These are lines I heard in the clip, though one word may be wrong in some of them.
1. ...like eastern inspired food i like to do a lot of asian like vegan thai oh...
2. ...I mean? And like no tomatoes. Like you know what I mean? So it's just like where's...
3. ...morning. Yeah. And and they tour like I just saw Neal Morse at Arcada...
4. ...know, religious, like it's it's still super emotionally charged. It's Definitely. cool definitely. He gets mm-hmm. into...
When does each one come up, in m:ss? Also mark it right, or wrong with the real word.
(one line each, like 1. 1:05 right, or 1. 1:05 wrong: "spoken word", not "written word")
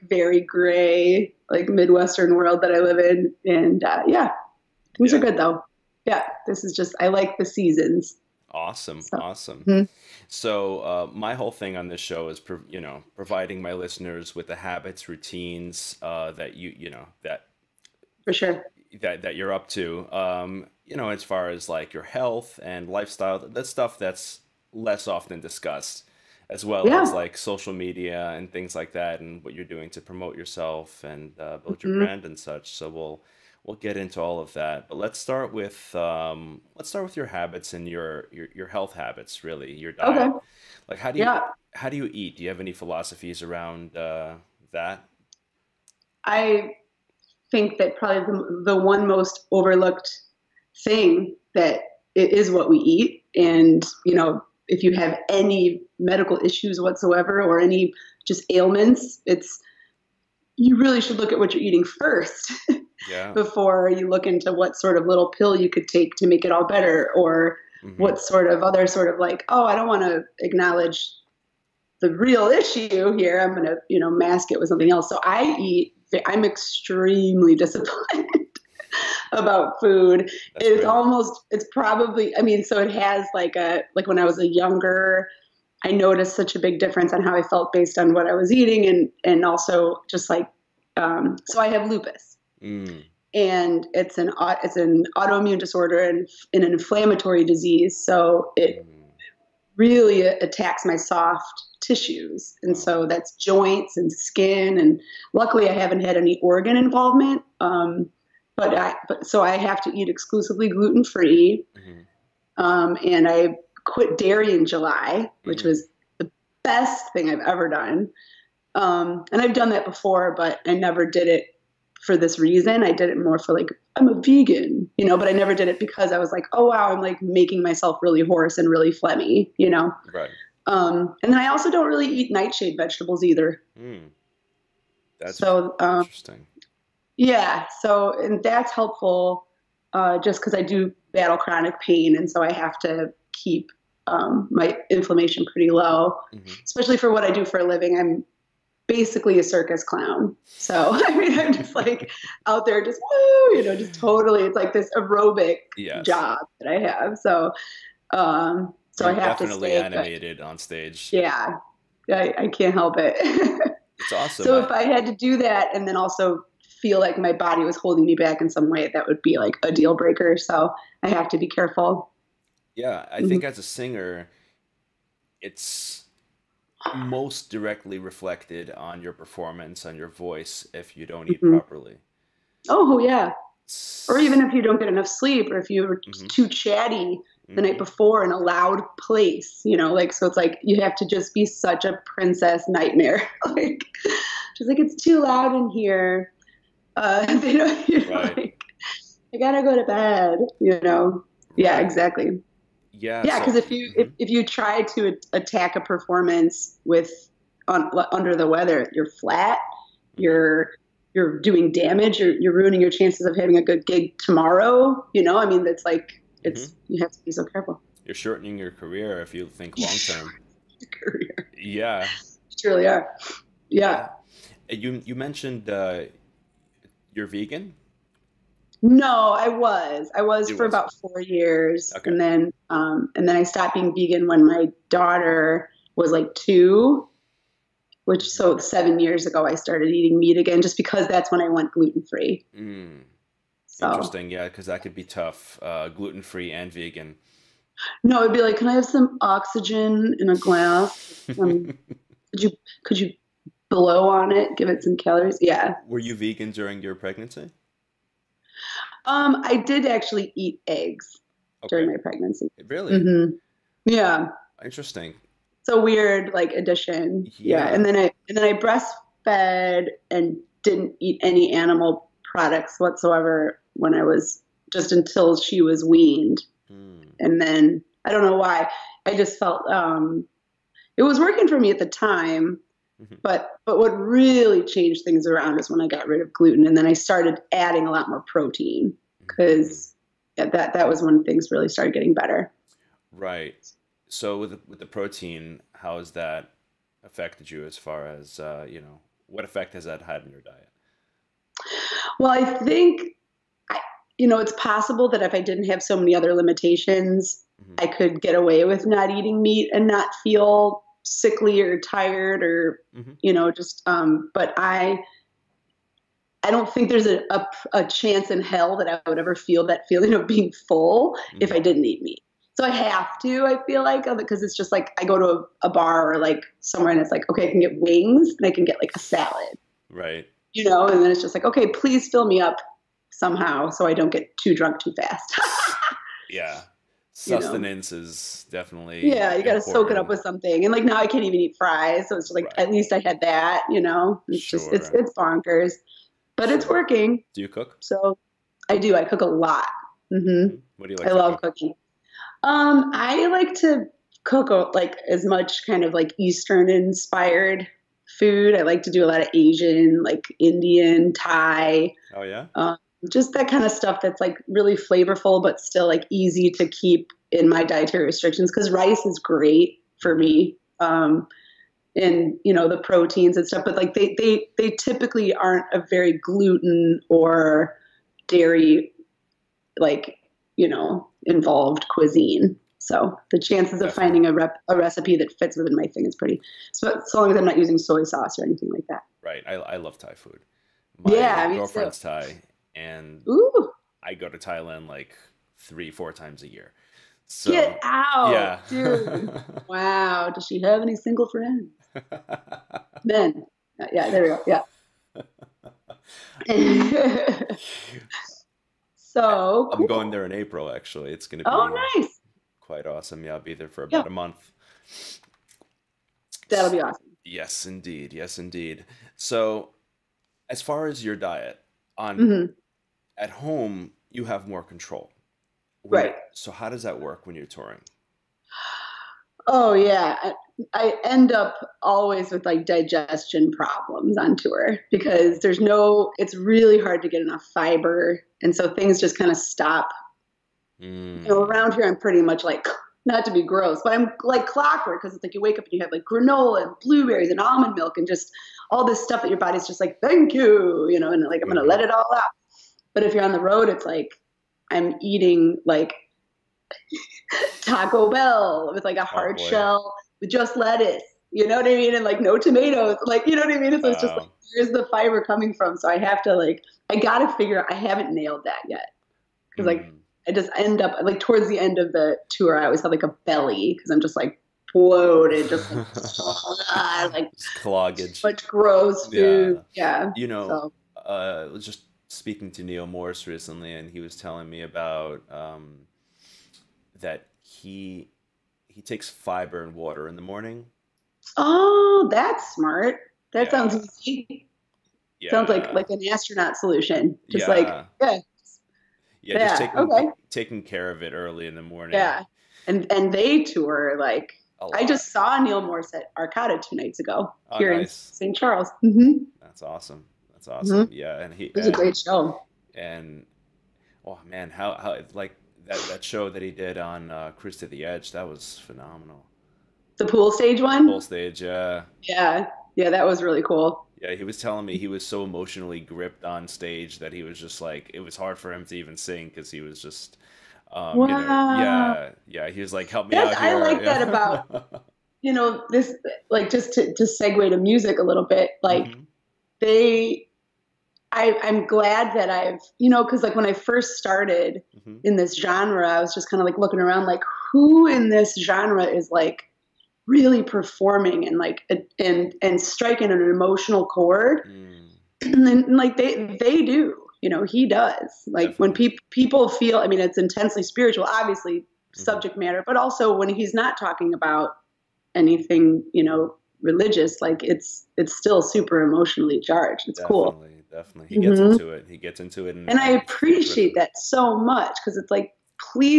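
1. 5:55 wrong: "indian", not "vegan"
2. 7:41 right
3. 8:21 right
4. 9:26 right.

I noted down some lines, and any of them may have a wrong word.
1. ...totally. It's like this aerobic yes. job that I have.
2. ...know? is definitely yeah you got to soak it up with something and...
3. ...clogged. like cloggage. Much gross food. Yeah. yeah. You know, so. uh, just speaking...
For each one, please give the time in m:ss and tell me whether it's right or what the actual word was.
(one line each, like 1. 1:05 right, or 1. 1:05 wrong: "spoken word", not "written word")
1. 2:33 right
2. 5:37 right
3. 7:55 right.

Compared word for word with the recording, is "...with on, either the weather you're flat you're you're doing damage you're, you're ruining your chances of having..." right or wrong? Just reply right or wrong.
wrong.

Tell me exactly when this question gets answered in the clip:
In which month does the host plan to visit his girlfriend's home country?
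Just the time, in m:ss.
6:50.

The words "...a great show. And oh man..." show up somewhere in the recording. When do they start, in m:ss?
8:31.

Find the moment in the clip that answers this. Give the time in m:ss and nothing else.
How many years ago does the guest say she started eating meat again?
3:58.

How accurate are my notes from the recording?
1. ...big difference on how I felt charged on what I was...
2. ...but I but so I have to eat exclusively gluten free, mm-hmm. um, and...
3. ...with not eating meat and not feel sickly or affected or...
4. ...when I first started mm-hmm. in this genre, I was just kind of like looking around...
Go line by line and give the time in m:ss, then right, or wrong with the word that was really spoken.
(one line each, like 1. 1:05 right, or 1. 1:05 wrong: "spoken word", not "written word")
1. 1:26 wrong: "based", not "charged"
2. 1:48 right
3. 5:08 wrong: "tired", not "affected"
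4. 9:03 right.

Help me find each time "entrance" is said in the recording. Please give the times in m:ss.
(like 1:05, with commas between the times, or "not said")
not said.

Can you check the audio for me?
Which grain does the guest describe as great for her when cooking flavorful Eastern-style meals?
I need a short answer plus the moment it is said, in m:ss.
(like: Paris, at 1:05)
Rice, at 6:08.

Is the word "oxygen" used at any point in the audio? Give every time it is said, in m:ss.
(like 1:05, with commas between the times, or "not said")
4:09.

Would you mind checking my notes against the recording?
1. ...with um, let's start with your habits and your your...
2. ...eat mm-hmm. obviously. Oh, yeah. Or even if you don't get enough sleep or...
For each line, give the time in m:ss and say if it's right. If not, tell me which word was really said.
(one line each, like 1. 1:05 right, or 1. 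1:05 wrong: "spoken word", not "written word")
1. 0:35 right
2. 3:01 wrong: "properly", not "obviously".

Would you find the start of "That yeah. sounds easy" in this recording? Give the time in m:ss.
8:13.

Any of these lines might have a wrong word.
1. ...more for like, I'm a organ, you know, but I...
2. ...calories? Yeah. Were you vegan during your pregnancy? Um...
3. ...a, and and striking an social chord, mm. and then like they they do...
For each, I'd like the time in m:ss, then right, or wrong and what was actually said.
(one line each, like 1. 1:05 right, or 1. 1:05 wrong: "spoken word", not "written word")
1. 2:03 wrong: "vegan", not "organ"
2. 4:14 right
3. 9:11 wrong: "emotional", not "social".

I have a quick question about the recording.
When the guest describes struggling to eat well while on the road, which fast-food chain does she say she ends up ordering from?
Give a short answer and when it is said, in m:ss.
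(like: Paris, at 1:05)
Taco Bell, at 7:37.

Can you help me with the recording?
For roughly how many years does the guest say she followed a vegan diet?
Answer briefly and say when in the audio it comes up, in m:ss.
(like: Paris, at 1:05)
4, at 3:50.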